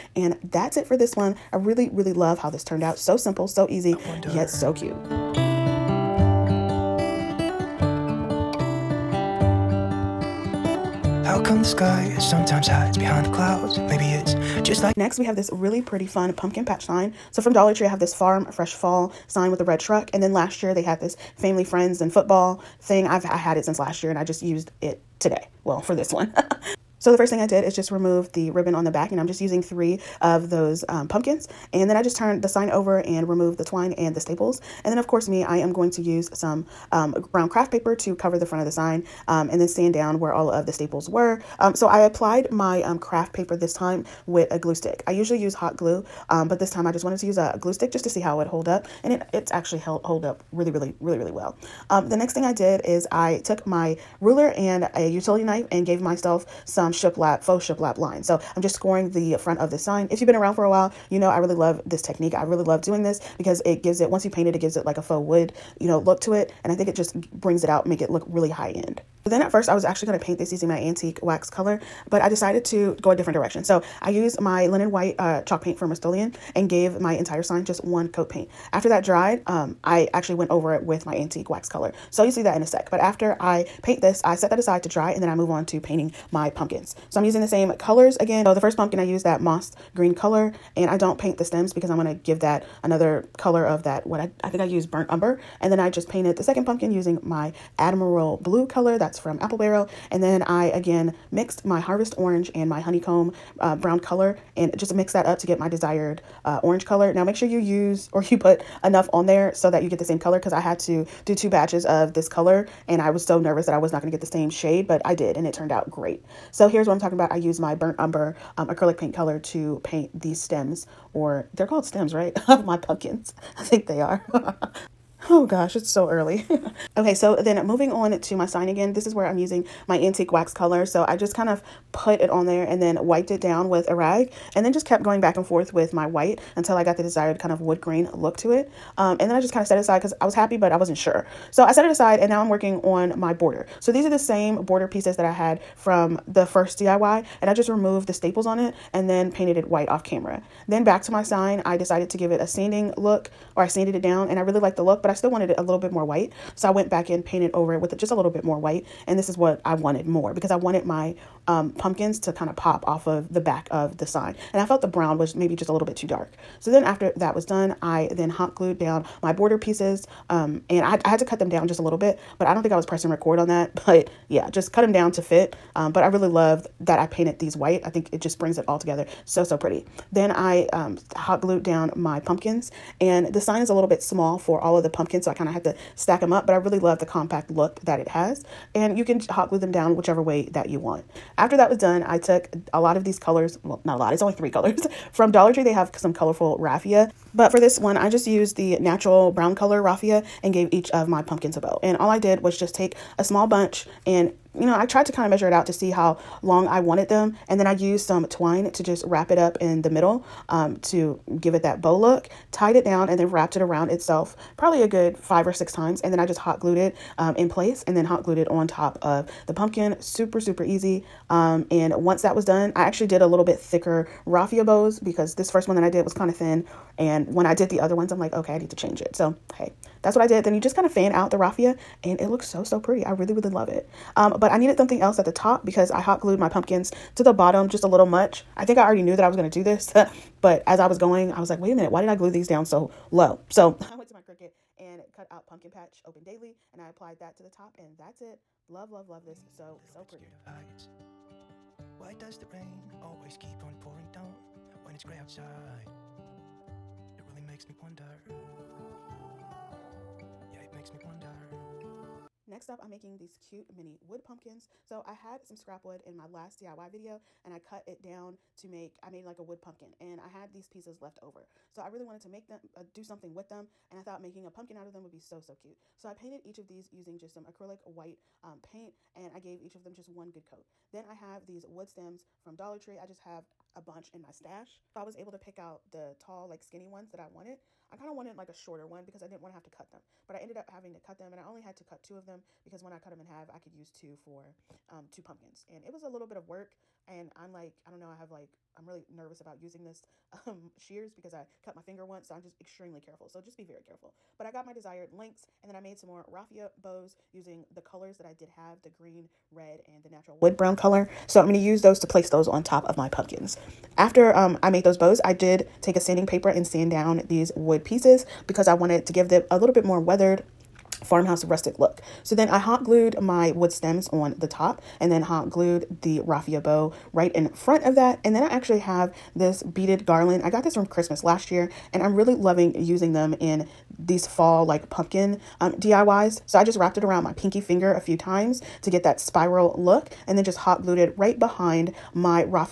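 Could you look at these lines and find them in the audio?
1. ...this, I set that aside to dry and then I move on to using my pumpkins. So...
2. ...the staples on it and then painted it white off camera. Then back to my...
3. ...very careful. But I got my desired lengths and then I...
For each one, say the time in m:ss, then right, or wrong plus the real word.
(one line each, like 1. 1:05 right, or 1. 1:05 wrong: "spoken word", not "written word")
1. 1:24 wrong: "painting", not "using"
2. 2:28 right
3. 5:03 right.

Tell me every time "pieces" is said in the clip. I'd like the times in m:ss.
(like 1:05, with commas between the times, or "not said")
2:24, 2:49, 4:30, 5:17.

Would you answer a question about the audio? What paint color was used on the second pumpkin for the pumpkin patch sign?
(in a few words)
admiral blue.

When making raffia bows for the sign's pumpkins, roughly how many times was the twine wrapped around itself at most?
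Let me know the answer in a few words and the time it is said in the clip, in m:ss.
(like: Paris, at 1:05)
6, at 3:35.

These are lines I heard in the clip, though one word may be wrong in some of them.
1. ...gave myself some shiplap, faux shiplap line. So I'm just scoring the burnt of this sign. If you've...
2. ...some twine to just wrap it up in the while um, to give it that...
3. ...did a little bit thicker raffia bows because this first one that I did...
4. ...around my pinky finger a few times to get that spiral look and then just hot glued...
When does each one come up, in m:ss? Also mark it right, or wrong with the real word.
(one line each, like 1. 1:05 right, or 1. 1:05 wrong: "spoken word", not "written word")
1. 0:55 wrong: "front", not "burnt"
2. 3:28 wrong: "middle", not "while"
3. 3:43 right
4. 5:37 right.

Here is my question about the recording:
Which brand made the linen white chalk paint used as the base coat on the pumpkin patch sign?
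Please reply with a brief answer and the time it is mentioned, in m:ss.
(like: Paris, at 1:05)
Rust-Oleum, at 1:15.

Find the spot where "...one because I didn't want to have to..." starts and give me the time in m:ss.
4:48.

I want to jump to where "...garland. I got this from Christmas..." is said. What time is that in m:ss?
5:30.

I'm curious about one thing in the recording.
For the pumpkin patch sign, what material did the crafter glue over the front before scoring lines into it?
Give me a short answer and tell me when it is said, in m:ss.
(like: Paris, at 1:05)
brown craft paper, at 0:37.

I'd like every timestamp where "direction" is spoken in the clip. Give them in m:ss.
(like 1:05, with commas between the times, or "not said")
1:13.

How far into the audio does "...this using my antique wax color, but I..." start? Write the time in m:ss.
1:10.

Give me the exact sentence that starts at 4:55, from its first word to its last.
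And it was a little bit of work.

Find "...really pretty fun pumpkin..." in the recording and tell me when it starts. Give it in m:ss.
0:15.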